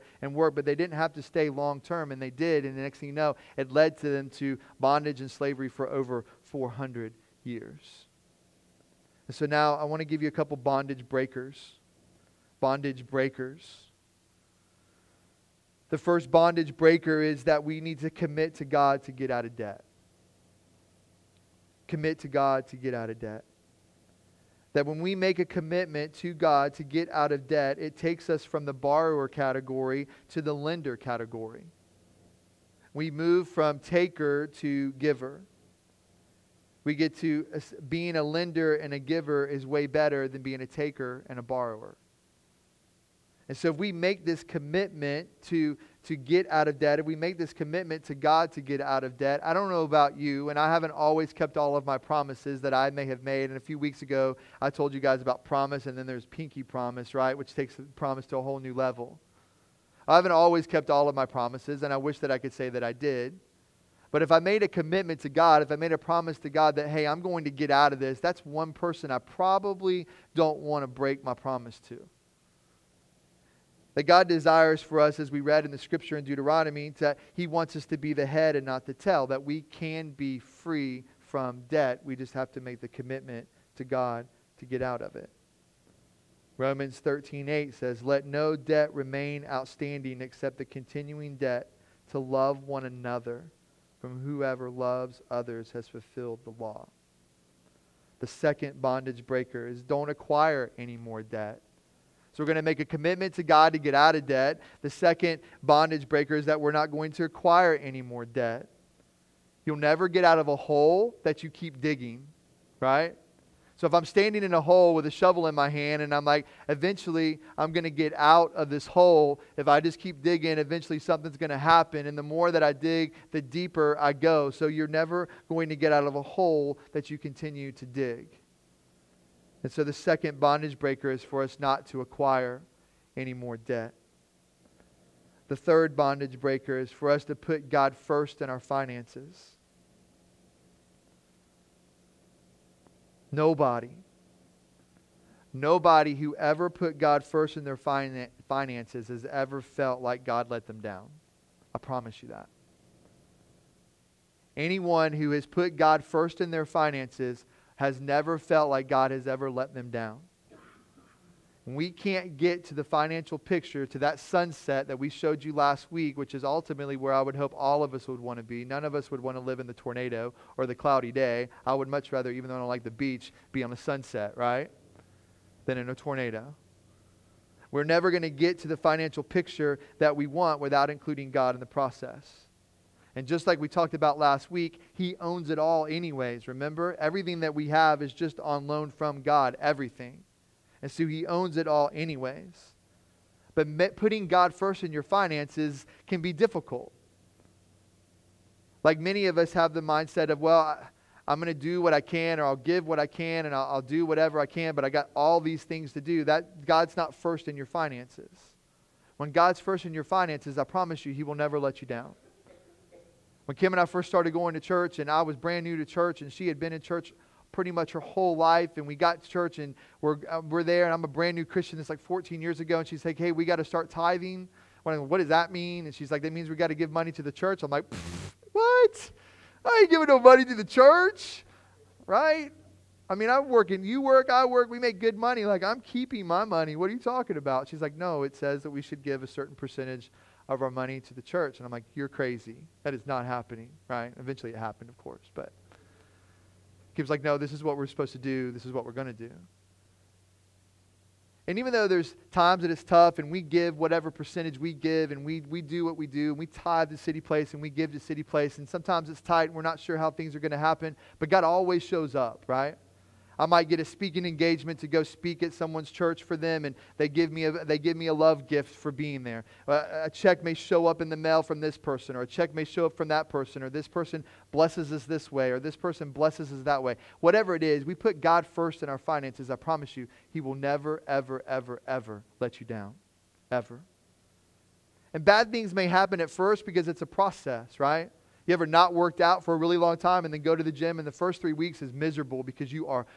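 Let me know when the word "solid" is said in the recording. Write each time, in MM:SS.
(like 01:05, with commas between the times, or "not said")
not said.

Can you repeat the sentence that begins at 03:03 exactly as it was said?
And just like we talked about last week, he owns it all, anyways.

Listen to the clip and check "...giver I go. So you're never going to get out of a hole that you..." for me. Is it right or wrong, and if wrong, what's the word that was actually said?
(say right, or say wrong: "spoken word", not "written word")
wrong: "deeper", not "giver".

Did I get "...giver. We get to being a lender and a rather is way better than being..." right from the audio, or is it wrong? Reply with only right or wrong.
wrong.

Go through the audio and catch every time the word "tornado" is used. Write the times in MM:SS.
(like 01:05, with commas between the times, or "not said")
02:49, 02:55.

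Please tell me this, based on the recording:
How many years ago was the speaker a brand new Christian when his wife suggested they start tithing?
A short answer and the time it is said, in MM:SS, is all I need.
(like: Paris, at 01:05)
14, at 03:42.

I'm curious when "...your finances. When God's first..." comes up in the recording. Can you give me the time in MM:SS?
03:27.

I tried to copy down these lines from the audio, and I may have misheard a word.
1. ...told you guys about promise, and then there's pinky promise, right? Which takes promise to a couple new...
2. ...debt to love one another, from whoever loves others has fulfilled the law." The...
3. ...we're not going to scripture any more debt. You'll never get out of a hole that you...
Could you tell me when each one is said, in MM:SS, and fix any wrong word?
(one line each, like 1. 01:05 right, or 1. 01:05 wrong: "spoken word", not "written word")
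1. 00:54 wrong: "whole", not "couple"
2. 01:31 right
3. 01:46 wrong: "acquire", not "scripture".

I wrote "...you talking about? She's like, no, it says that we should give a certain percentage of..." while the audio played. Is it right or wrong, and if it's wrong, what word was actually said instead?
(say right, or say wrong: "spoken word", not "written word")
right.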